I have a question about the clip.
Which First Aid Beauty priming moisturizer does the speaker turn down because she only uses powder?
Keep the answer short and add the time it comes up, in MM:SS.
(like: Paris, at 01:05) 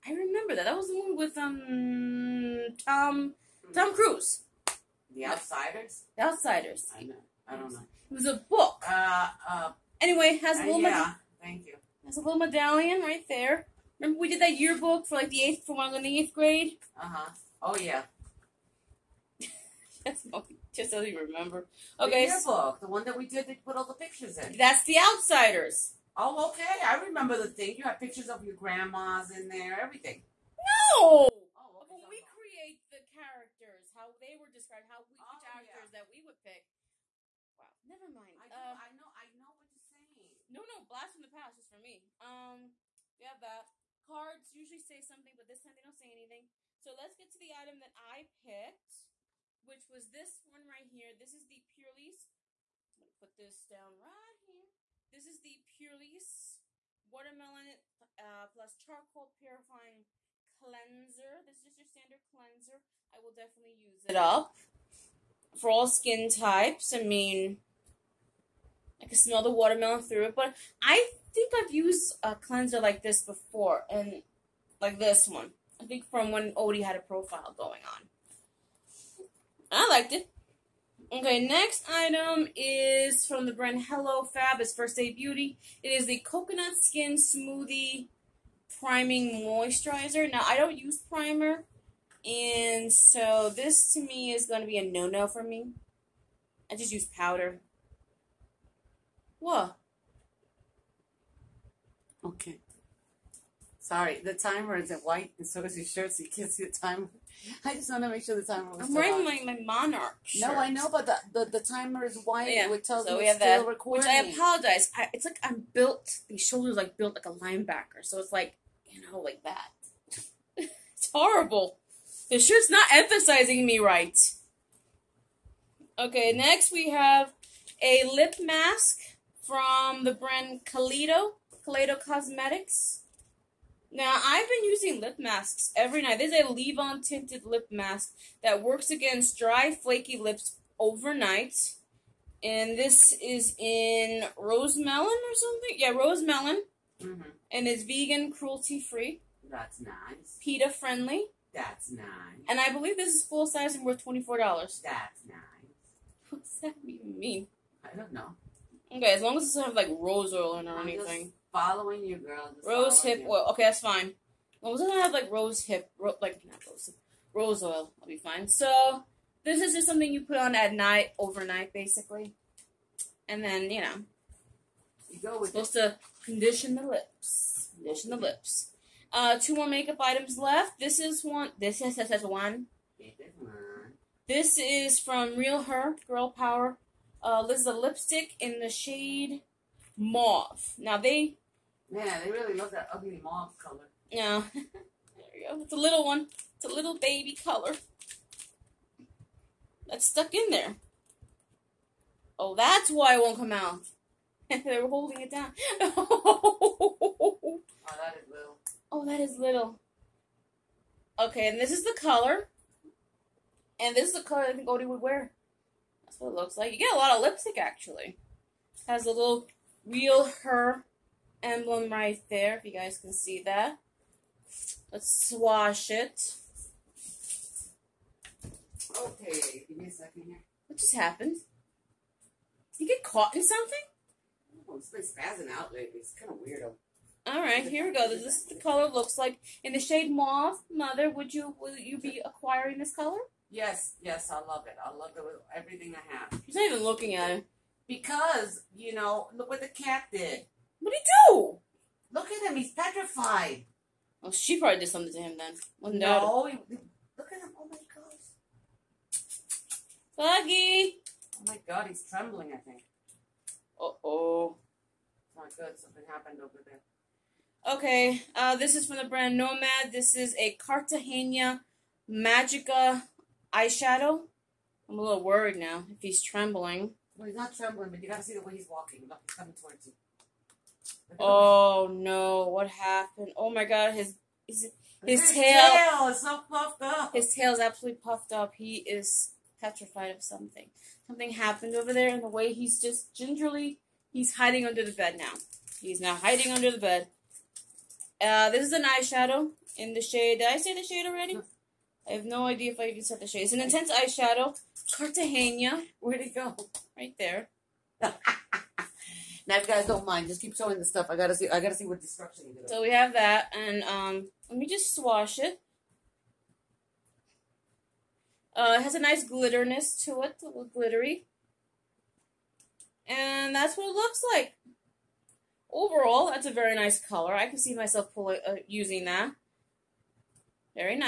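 Coconut Skin Smoothie, at 01:26.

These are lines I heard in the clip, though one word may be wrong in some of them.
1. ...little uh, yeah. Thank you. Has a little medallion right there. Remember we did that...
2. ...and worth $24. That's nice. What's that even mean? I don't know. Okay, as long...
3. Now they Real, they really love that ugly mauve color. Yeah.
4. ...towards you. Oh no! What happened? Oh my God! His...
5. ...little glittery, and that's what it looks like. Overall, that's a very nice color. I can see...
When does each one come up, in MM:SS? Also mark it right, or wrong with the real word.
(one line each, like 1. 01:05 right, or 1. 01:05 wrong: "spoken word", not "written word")
1. 00:10 right
2. 02:33 right
3. 03:10 wrong: "Man", not "Real"
4. 04:39 right
5. 05:20 right.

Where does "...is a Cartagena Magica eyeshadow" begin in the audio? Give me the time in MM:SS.
04:30.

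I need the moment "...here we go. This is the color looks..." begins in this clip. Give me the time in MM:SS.
03:57.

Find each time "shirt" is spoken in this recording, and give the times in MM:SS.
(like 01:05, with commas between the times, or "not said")
01:45, 01:50, 02:02.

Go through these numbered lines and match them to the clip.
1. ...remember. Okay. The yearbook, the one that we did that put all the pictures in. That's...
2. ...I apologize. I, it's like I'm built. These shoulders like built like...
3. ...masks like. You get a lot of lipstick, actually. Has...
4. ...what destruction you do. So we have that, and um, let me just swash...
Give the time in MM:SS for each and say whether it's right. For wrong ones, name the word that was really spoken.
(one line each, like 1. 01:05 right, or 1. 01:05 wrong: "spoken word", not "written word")
1. 00:21 right
2. 01:54 right
3. 03:36 wrong: "looks", not "masks"
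4. 05:11 right.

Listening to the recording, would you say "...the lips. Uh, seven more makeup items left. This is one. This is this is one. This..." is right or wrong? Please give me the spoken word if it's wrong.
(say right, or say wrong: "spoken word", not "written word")
wrong: "two", not "seven".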